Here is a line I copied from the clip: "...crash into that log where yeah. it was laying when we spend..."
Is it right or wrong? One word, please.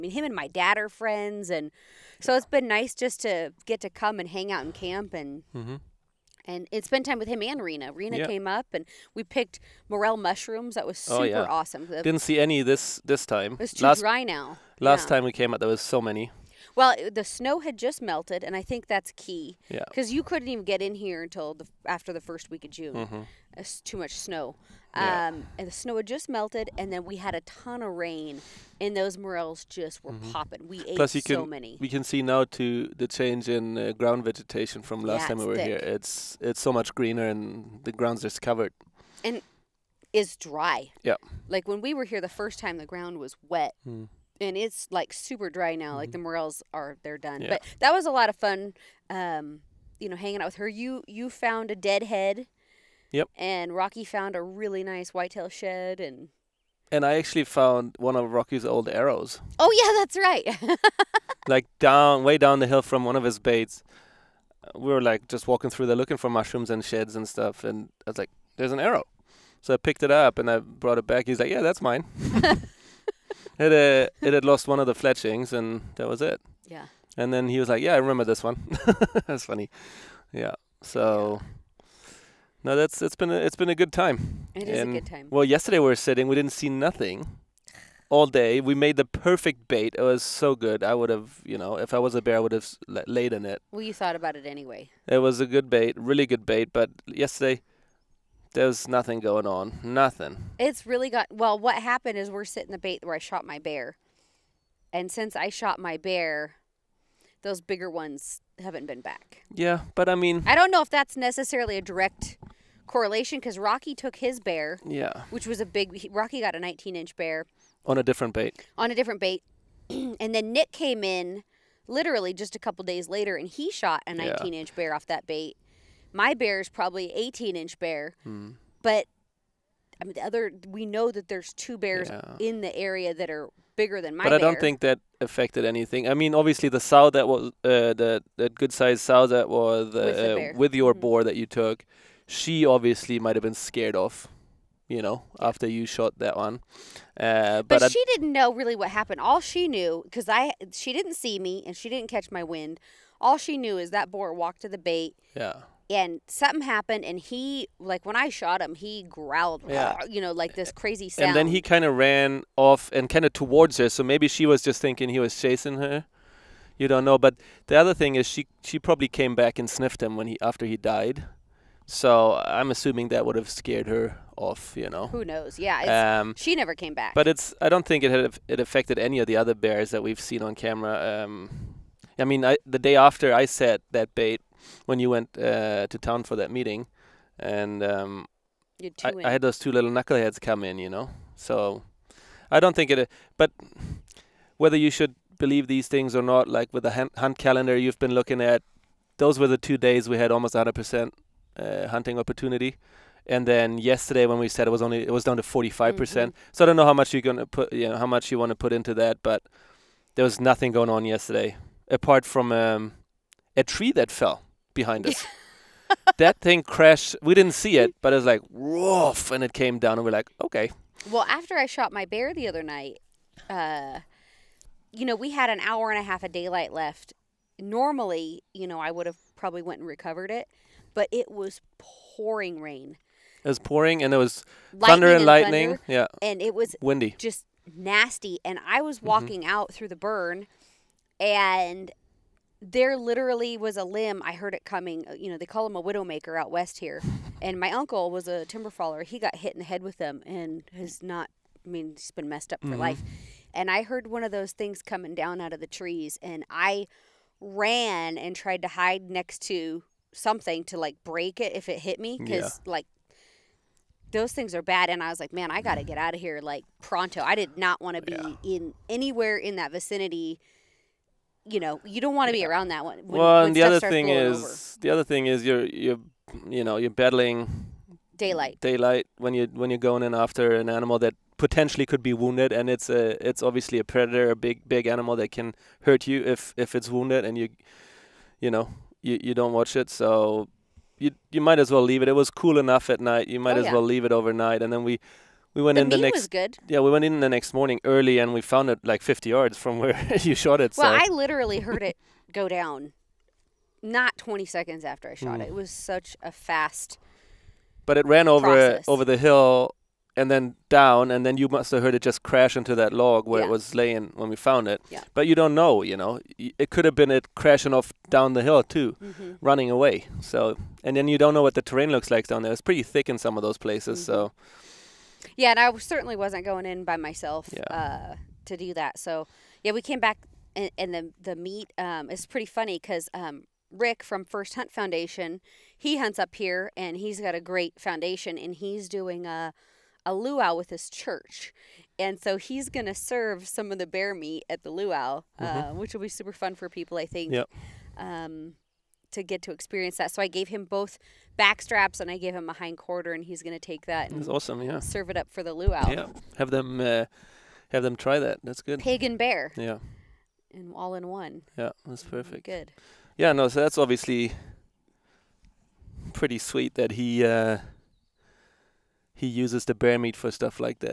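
wrong.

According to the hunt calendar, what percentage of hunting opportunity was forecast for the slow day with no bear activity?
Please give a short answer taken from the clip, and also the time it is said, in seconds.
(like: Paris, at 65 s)
45, at 205 s.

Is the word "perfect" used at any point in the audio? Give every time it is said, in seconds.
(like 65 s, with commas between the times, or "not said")
89 s, 362 s.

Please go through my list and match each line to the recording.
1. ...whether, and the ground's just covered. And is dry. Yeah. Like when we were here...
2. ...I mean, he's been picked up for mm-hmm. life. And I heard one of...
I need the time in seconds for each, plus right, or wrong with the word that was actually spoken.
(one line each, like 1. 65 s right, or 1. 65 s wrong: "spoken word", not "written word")
1. 36 s wrong: "greener", not "whether"
2. 251 s wrong: "messed", not "picked".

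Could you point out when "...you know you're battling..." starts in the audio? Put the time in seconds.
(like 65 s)
276 s.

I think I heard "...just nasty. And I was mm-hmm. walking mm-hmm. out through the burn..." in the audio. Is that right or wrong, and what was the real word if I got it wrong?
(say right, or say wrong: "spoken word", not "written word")
right.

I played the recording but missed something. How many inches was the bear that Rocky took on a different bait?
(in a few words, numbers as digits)
19.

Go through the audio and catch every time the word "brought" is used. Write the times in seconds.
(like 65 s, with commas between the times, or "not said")
70 s.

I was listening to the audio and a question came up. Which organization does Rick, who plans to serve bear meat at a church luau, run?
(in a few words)
First Hunt Foundation.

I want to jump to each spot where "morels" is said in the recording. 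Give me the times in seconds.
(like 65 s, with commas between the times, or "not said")
9 s, 29 s, 46 s.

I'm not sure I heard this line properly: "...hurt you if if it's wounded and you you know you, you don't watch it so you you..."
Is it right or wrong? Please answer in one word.
right.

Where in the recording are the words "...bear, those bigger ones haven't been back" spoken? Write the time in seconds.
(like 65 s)
105 s.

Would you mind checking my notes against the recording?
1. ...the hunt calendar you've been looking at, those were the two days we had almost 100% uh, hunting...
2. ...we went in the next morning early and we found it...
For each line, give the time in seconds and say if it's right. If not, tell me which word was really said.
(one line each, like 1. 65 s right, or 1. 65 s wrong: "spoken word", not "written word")
1. 196 s right
2. 296 s right.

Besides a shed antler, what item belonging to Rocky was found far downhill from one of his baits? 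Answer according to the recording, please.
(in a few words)
An arrow.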